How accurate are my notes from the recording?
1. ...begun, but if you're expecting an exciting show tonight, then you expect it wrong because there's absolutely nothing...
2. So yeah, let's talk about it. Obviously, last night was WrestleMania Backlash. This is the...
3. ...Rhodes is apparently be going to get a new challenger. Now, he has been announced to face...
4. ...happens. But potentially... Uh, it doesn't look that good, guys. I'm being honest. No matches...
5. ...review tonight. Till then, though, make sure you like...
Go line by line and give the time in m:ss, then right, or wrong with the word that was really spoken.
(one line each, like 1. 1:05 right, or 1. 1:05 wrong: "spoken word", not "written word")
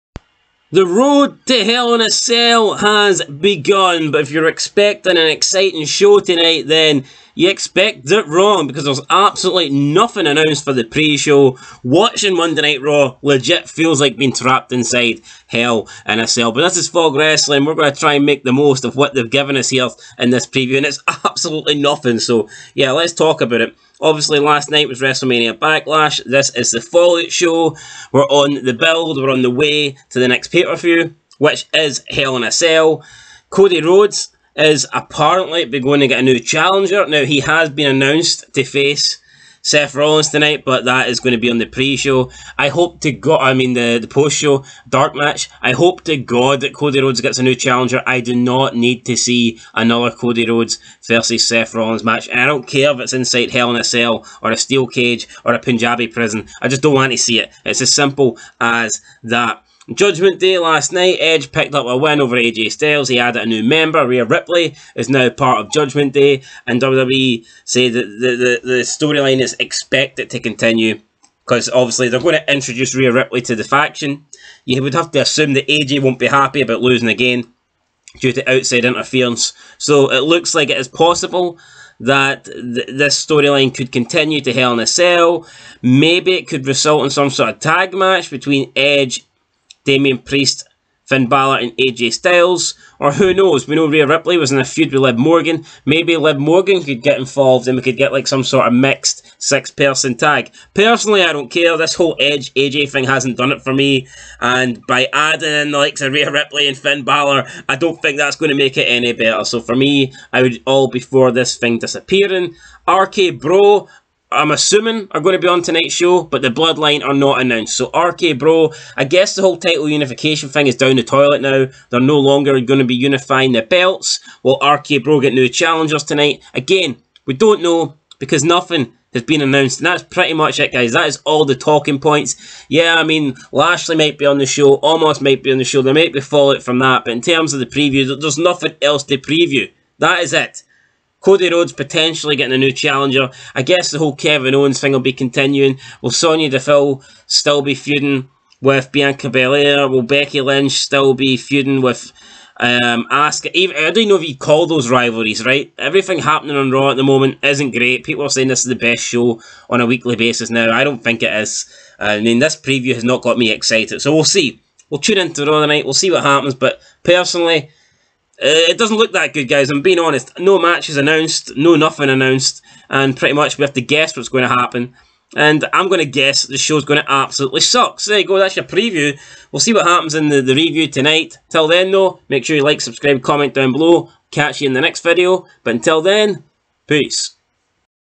1. 0:03 right
2. 0:22 right
3. 0:33 right
4. 2:46 wrong: "personally", not "potentially"
5. 3:00 right.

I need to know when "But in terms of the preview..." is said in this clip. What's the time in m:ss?
2:17.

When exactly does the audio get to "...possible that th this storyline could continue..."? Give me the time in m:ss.
1:20.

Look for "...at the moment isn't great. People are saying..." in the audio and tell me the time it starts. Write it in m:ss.
2:36.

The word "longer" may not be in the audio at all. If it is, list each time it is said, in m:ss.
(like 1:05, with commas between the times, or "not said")
2:02.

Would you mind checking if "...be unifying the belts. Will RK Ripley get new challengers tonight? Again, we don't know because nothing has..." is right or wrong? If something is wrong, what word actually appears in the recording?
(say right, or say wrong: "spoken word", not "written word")
wrong: "Bro", not "Ripley".